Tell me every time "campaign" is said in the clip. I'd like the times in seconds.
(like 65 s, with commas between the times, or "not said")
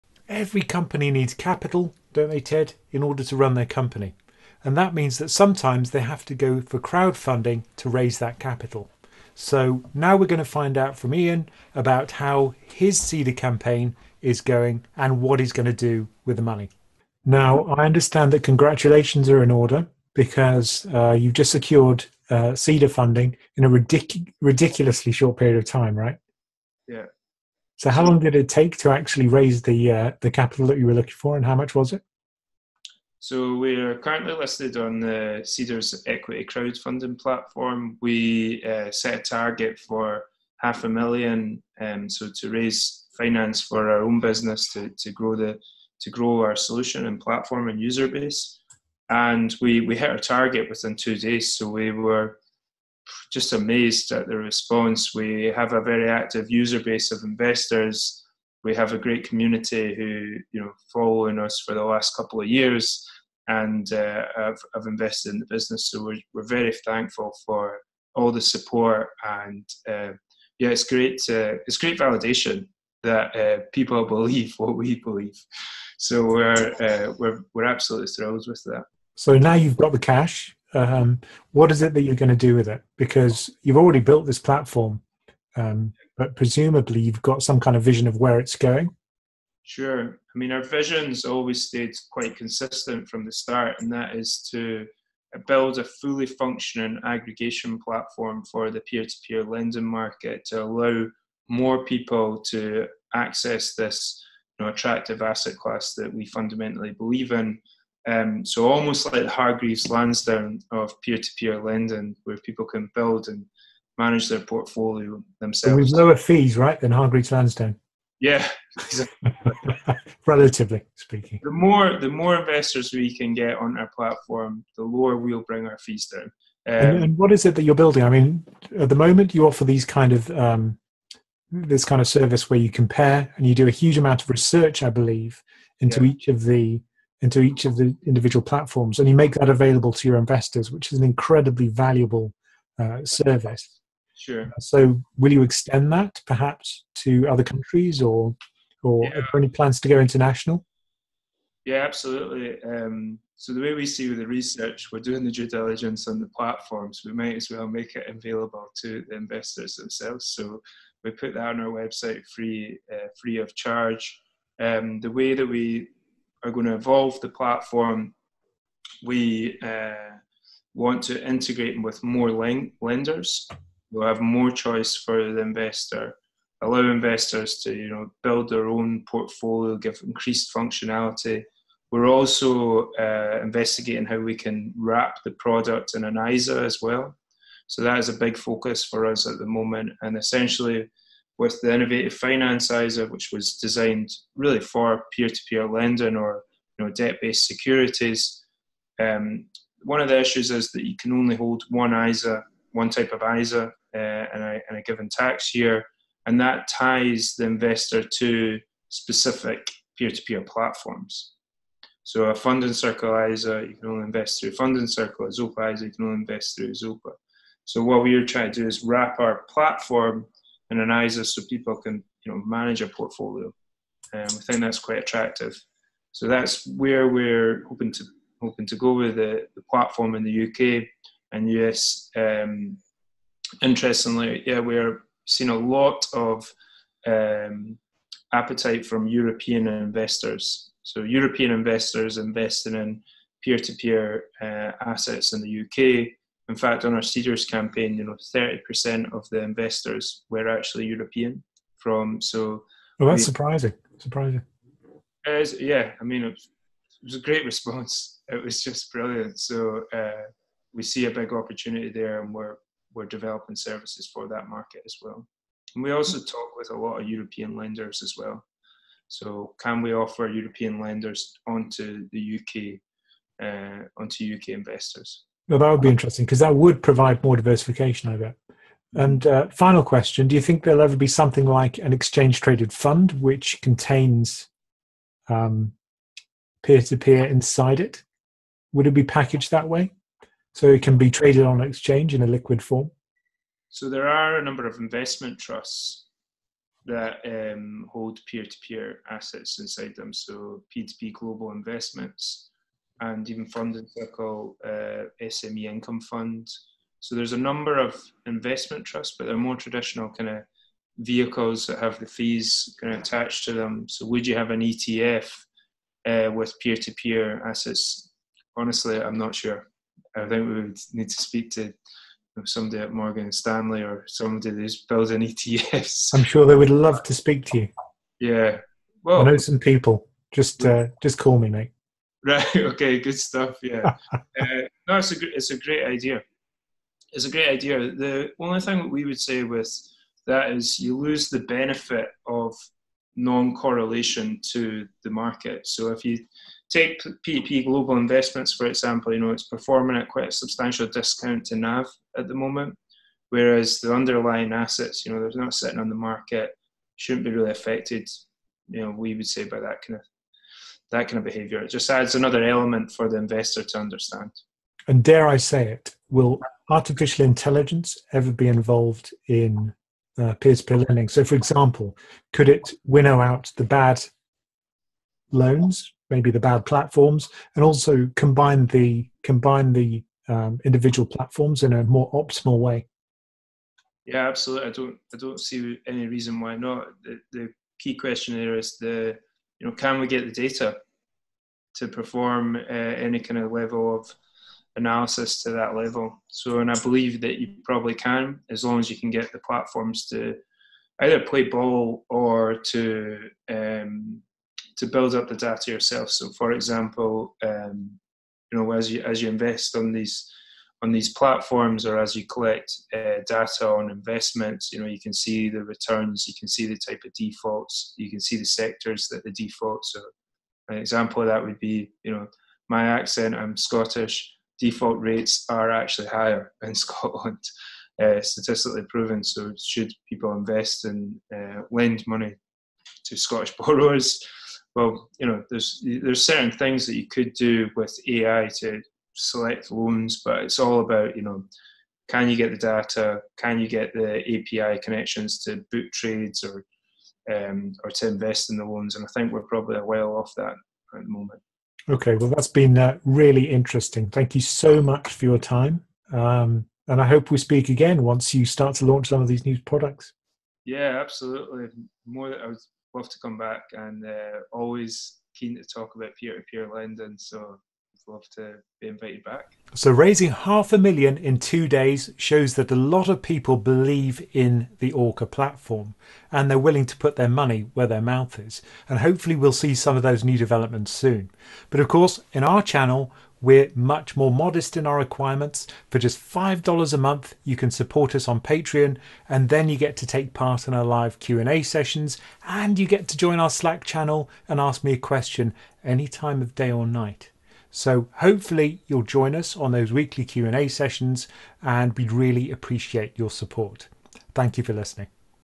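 13 s, 247 s.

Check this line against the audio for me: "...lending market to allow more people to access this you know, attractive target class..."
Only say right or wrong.
wrong.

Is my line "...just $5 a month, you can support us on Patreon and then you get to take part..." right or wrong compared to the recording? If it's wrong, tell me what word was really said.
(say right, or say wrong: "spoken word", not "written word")
right.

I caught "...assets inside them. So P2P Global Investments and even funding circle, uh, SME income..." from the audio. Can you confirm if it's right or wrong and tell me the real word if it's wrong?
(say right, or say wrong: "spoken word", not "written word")
right.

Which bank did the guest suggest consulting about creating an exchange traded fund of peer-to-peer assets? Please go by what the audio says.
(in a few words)
Morgan Stanley.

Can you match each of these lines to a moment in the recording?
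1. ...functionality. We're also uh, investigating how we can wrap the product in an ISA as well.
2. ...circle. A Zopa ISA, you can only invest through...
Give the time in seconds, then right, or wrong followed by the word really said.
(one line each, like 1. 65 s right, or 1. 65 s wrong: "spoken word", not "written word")
1. 180 s right
2. 214 s right.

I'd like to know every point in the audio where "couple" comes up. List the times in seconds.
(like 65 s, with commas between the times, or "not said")
62 s.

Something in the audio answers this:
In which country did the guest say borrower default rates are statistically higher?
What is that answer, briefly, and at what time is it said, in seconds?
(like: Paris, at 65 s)
Scotland, at 426 s.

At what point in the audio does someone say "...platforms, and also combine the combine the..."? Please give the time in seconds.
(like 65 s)
376 s.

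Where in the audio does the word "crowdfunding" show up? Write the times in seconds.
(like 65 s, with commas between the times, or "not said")
6 s, 36 s.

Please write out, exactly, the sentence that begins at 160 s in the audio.
So we put that on our website free, uh, free of charge.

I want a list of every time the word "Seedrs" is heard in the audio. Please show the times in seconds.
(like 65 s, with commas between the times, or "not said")
12 s, 35 s, 247 s.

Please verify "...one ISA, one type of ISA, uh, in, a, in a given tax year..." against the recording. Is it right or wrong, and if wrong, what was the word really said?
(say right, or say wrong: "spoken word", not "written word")
right.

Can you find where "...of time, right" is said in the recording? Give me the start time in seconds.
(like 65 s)
25 s.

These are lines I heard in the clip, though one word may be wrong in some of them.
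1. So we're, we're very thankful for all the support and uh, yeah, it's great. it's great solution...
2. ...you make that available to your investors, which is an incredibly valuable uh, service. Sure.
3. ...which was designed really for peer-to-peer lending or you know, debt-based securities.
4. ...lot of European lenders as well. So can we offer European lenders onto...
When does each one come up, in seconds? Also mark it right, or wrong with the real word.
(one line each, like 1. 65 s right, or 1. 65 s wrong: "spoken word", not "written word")
1. 65 s wrong: "validation", not "solution"
2. 139 s right
3. 193 s right
4. 266 s right.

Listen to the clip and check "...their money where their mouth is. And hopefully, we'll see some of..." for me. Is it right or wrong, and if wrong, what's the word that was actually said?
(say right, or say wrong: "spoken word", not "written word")
right.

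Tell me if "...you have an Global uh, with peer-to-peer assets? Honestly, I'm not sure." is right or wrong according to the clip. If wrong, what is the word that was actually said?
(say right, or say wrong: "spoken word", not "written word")
wrong: "ETF", not "Global".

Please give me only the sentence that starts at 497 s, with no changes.
So hopefully you'll join us on those weekly Q&A sessions and we'd really appreciate your support.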